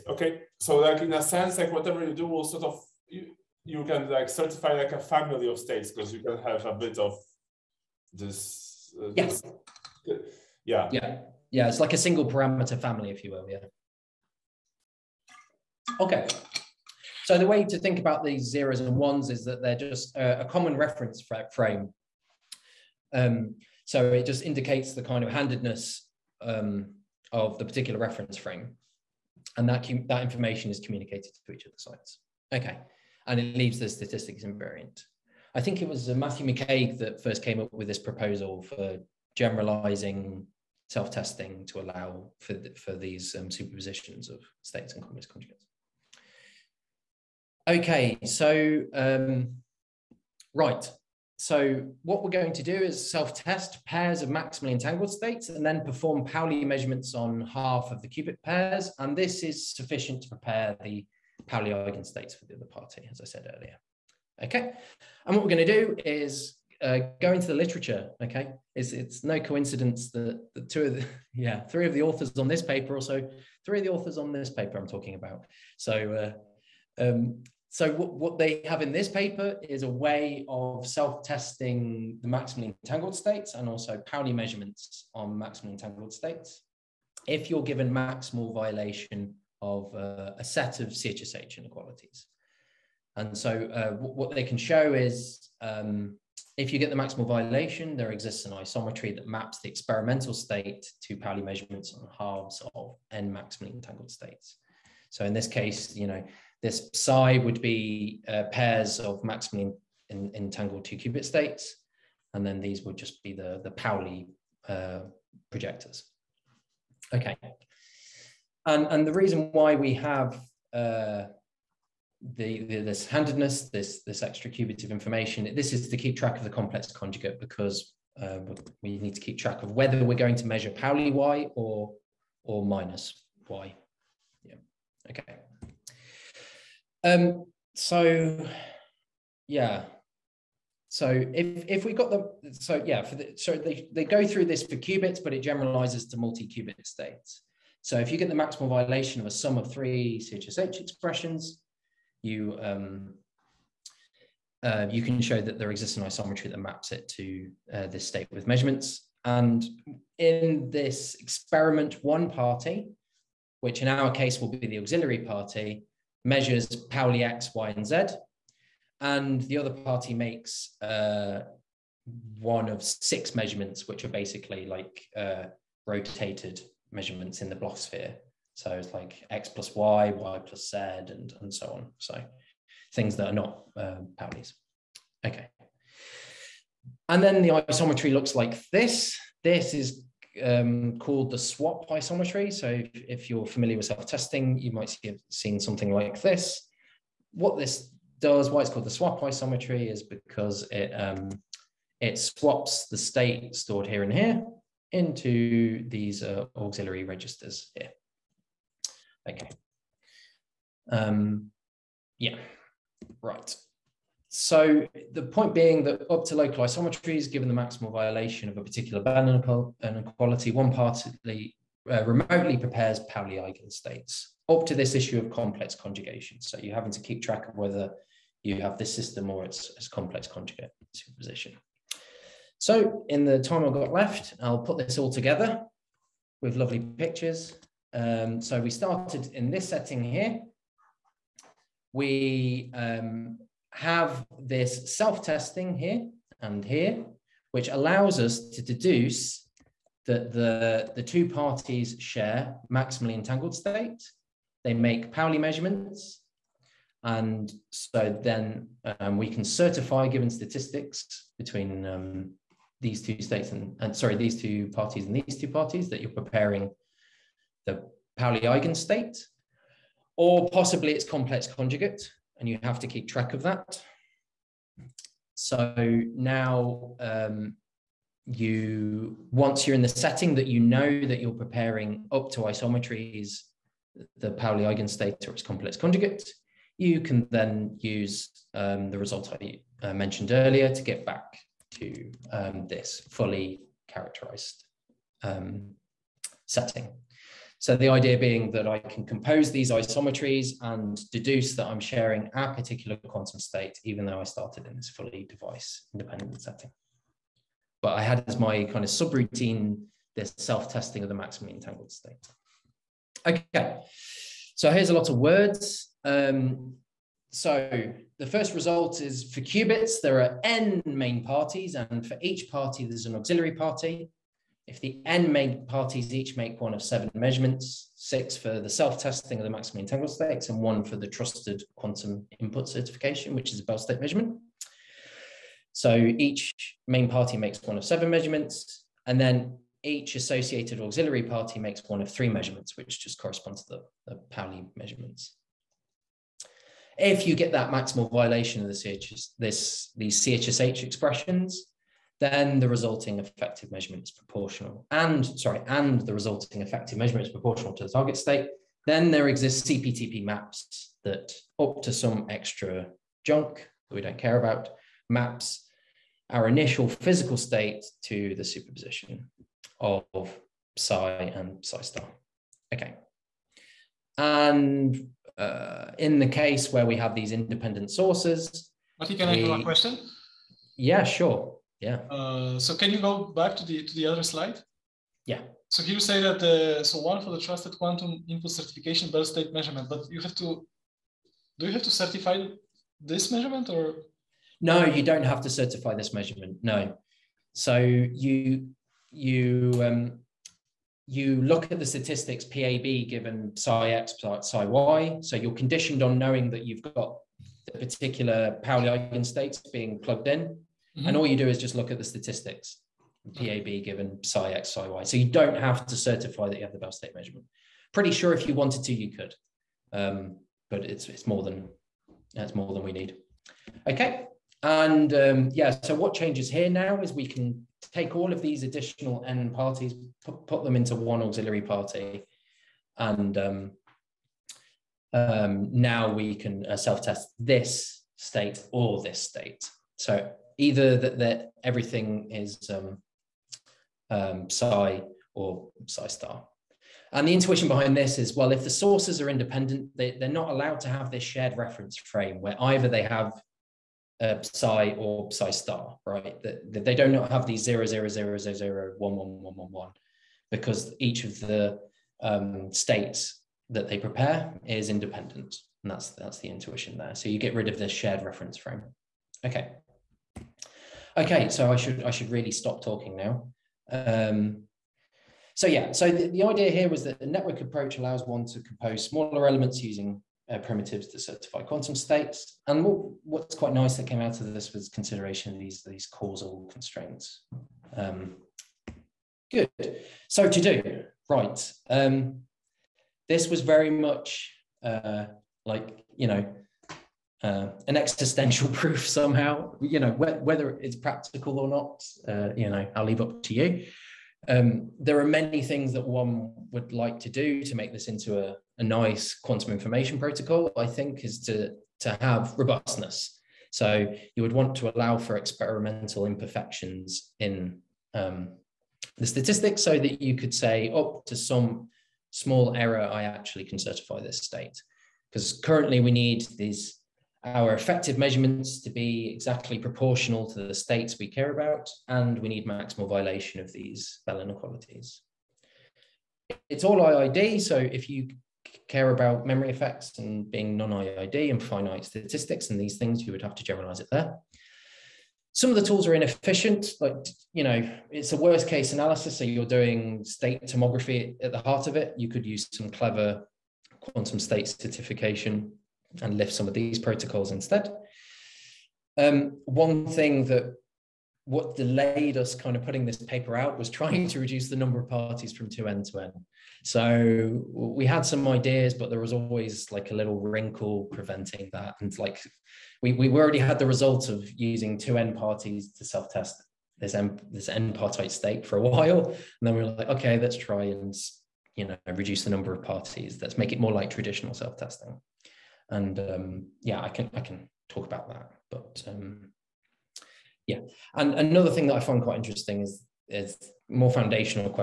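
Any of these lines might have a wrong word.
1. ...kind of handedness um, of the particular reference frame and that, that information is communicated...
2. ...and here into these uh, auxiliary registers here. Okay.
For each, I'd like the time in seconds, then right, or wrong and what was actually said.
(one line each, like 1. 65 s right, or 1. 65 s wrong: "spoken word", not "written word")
1. 25 s right
2. 204 s right.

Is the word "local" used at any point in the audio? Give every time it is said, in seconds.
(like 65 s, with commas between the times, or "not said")
216 s.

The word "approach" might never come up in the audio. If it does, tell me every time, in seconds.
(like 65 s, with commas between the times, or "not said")
477 s.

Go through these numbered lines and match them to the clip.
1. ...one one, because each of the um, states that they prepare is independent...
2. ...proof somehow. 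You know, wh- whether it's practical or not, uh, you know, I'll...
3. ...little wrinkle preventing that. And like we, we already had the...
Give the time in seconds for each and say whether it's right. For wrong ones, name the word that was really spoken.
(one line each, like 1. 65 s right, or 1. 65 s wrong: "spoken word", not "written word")
1. 459 s right
2. 498 s right
3. 570 s right.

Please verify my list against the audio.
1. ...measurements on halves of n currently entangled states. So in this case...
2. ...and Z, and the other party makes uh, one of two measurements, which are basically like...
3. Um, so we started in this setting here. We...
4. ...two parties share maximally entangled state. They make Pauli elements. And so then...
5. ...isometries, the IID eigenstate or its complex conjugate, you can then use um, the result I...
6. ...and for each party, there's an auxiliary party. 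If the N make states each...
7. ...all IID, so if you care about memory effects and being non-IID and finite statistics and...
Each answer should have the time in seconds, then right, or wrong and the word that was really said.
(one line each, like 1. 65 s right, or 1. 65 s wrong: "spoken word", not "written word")
1. 101 s wrong: "maximally", not "currently"
2. 167 s wrong: "six", not "two"
3. 237 s right
4. 251 s wrong: "measurements", not "elements"
5. 282 s wrong: "Pauli", not "IID"
6. 321 s wrong: "parties", not "states"
7. 536 s right.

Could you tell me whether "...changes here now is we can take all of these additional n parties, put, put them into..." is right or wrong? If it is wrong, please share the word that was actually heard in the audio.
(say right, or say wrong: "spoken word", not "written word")
right.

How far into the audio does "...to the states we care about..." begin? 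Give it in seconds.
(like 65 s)
530 s.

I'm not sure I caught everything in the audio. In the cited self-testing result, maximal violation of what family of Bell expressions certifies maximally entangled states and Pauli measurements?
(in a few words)
CHSH inequalities.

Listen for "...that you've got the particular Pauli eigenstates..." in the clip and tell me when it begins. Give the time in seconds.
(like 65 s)
406 s.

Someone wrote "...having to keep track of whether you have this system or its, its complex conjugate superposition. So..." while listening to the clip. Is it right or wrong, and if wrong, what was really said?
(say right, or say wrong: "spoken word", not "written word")
right.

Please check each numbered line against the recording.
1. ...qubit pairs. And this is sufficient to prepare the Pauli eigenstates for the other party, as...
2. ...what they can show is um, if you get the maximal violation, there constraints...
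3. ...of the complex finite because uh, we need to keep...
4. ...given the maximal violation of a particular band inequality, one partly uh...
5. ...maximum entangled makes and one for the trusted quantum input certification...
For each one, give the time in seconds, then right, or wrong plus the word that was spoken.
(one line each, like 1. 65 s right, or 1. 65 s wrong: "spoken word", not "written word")
1. 58 s right
2. 93 s wrong: "exists", not "constraints"
3. 126 s wrong: "conjugate", not "finite"
4. 217 s right
5. 329 s wrong: "states", not "makes".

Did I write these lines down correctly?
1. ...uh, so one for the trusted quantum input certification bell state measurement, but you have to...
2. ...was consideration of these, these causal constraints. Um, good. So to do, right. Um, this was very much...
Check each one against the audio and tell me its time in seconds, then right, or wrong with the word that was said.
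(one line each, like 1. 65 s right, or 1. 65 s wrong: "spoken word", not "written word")
1. 386 s right
2. 484 s right.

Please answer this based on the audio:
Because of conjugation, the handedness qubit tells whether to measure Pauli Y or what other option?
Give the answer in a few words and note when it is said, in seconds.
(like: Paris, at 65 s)
minus Y, at 132 s.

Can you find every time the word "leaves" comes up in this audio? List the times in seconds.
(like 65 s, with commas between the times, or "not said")
33 s, 503 s.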